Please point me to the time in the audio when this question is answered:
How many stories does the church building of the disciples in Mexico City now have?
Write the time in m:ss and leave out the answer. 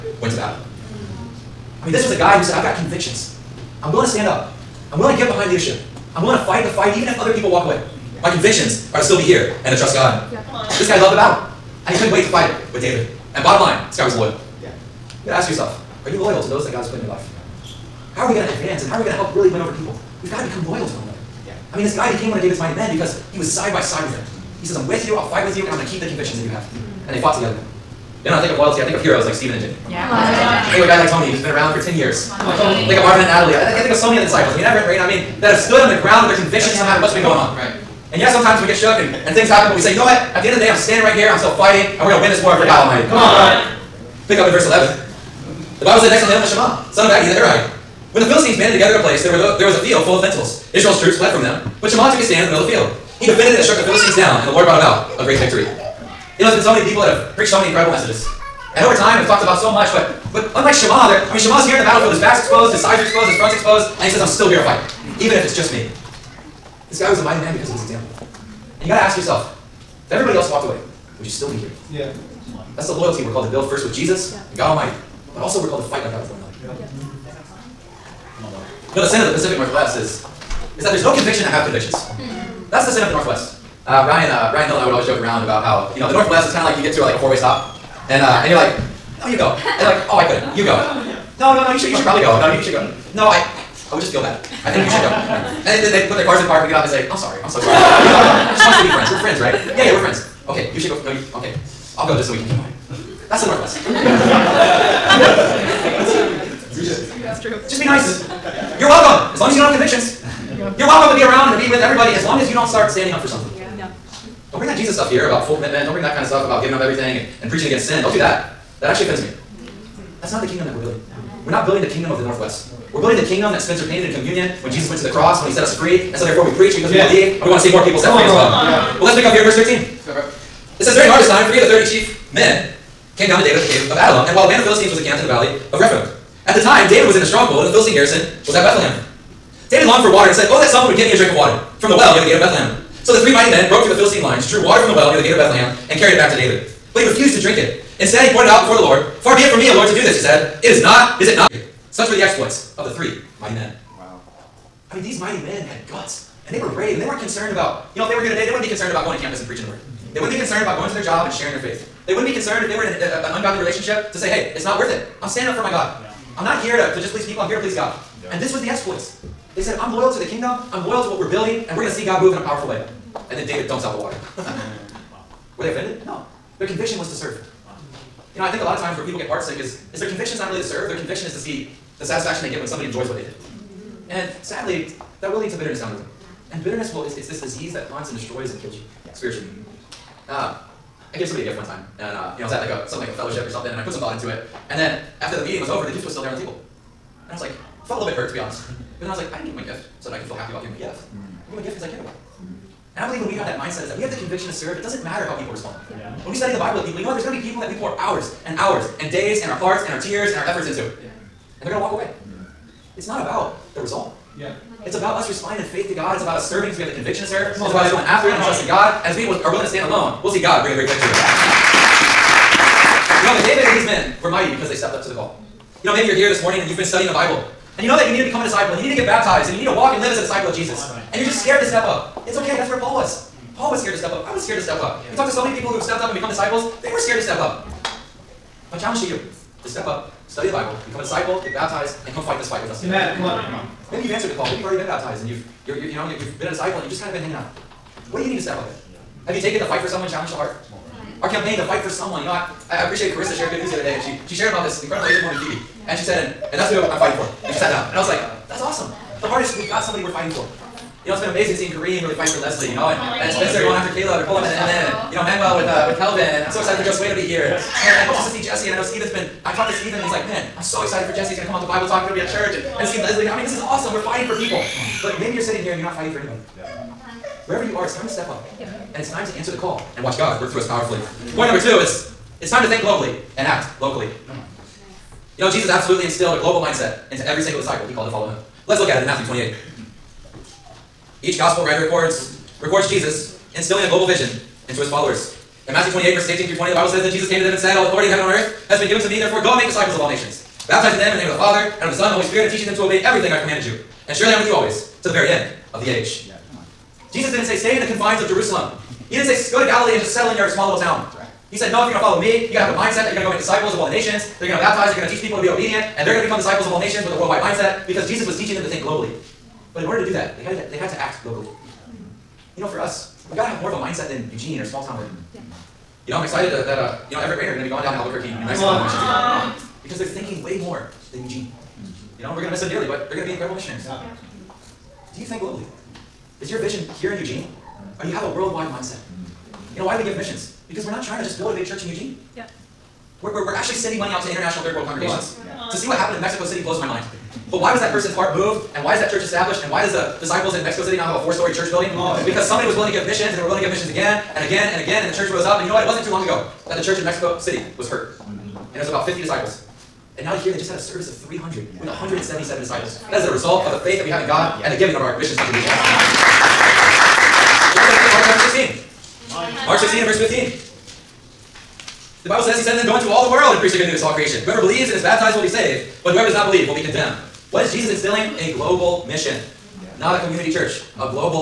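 5:51.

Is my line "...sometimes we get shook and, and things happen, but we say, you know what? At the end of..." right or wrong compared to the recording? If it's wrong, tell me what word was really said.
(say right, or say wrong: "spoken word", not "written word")
right.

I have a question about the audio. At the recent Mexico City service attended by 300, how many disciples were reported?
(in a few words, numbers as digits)
177.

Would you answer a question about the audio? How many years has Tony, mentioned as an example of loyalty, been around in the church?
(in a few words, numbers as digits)
10.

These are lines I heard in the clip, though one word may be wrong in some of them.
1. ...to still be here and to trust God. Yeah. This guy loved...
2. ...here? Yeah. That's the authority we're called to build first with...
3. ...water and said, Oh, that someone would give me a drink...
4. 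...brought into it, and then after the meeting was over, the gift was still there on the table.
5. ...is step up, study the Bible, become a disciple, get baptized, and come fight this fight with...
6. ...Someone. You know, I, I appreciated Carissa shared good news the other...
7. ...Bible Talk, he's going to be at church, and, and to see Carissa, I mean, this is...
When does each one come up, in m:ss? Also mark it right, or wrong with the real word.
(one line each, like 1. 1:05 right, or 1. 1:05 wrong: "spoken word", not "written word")
1. 0:08 right
2. 1:11 wrong: "loyalty", not "authority"
3. 2:20 right
4. 3:13 wrong: "thought", not "brought"
5. 3:59 right
6. 4:11 right
7. 4:31 wrong: "Leslie", not "Carissa".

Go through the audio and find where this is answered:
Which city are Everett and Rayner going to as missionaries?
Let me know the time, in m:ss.
5:27.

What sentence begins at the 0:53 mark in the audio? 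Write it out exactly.
He defended it and struck the Philistines down, and the Lord brought about a great victory.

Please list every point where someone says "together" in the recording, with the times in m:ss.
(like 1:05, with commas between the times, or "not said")
0:27, 0:48.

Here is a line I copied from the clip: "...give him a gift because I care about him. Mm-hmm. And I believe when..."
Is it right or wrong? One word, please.
right.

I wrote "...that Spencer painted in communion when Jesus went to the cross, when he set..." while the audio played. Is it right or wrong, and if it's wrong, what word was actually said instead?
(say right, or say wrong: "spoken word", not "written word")
right.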